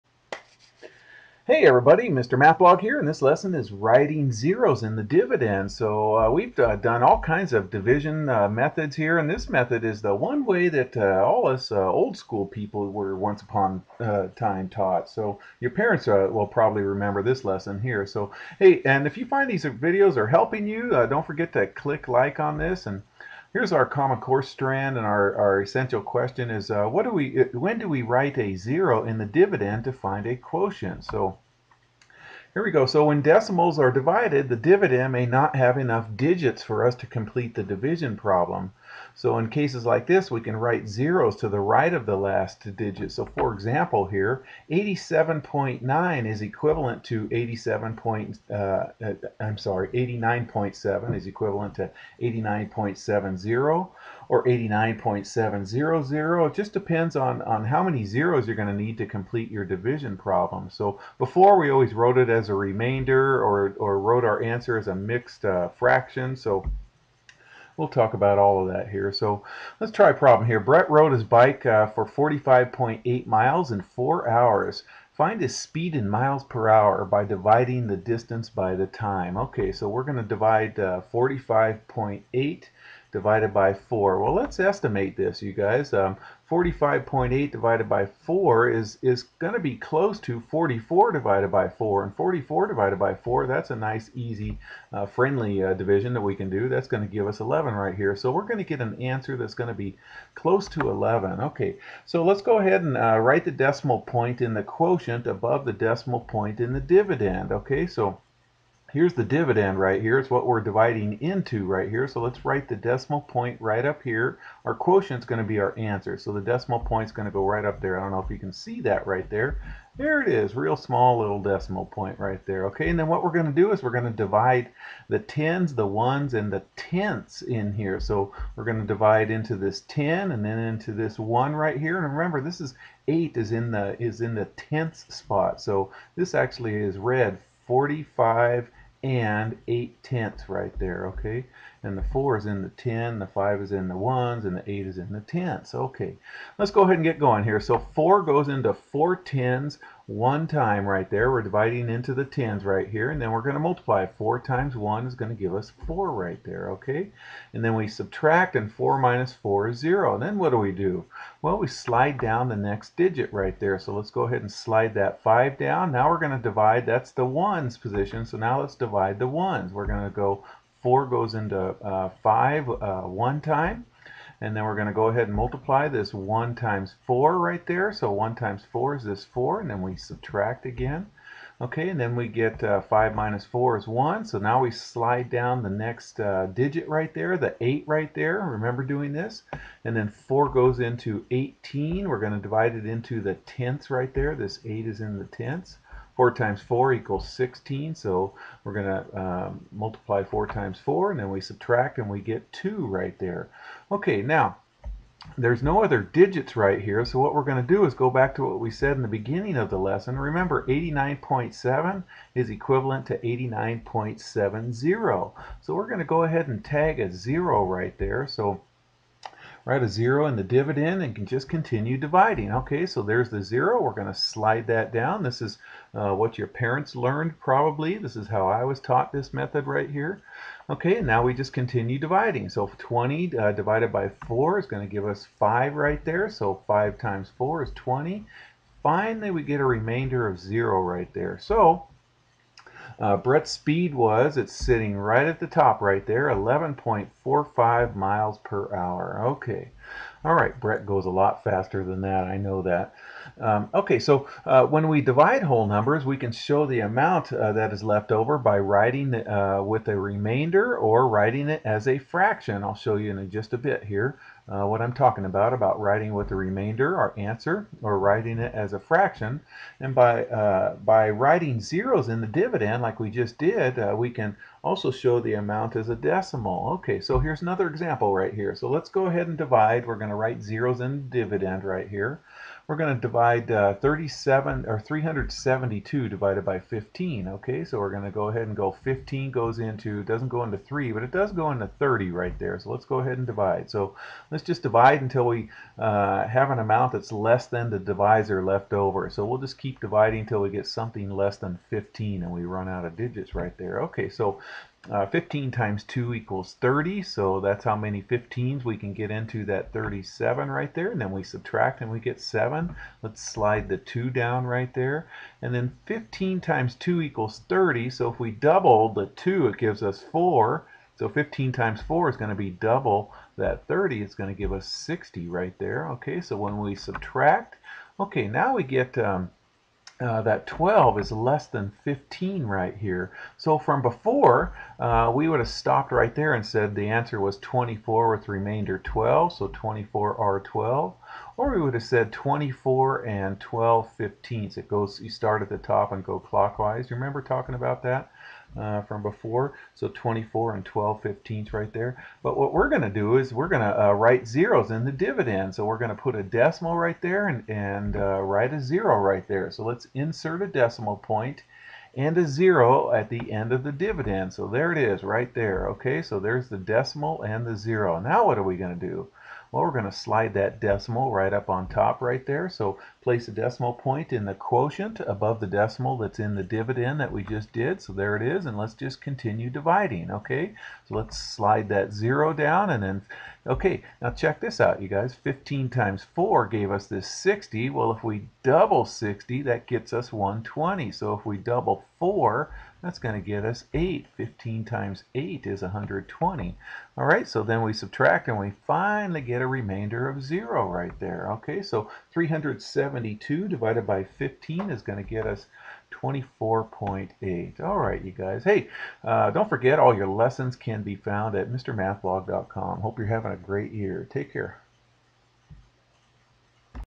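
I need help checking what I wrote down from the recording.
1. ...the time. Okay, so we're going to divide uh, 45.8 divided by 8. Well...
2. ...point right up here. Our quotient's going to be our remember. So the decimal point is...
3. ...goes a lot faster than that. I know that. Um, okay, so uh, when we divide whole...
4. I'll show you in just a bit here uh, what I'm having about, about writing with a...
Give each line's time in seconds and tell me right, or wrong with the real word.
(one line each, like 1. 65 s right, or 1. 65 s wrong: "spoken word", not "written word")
1. 78 s wrong: "4", not "8"
2. 113 s wrong: "answer", not "remember"
3. 250 s right
4. 262 s wrong: "talking", not "having".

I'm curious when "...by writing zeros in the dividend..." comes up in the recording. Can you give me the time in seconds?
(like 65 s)
270 s.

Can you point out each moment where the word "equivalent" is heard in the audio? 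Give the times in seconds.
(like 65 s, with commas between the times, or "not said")
46 s, 51 s, 212 s.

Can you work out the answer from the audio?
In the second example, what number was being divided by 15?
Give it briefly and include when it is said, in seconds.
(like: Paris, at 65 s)
372, at 284 s.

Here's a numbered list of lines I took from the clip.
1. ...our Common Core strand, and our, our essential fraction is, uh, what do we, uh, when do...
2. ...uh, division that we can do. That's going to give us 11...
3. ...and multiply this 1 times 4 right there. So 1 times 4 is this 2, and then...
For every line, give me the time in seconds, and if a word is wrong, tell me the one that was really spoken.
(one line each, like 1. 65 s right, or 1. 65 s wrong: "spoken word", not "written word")
1. 23 s wrong: "question", not "fraction"
2. 95 s right
3. 175 s wrong: "4", not "2".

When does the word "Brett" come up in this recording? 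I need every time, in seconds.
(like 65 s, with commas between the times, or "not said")
70 s, 243 s, 250 s.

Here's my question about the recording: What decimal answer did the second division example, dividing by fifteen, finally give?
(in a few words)
24.8.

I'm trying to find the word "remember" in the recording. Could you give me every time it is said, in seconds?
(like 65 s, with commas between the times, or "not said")
16 s, 132 s, 188 s, 210 s, 346 s.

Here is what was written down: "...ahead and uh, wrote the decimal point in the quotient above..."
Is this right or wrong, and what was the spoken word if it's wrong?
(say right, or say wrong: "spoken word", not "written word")
wrong: "write", not "wrote".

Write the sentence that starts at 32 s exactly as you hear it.
So when decimals are divided, the dividend may not have enough digits for us to complete the division problem.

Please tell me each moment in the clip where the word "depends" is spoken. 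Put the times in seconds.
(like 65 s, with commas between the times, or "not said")
56 s.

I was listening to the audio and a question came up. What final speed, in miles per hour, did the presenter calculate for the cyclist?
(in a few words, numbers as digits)
11.45.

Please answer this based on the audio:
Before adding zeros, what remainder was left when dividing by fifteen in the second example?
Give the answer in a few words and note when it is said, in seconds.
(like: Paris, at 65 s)
12, at 338 s.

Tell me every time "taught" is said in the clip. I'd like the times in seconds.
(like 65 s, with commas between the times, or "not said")
14 s, 228 s.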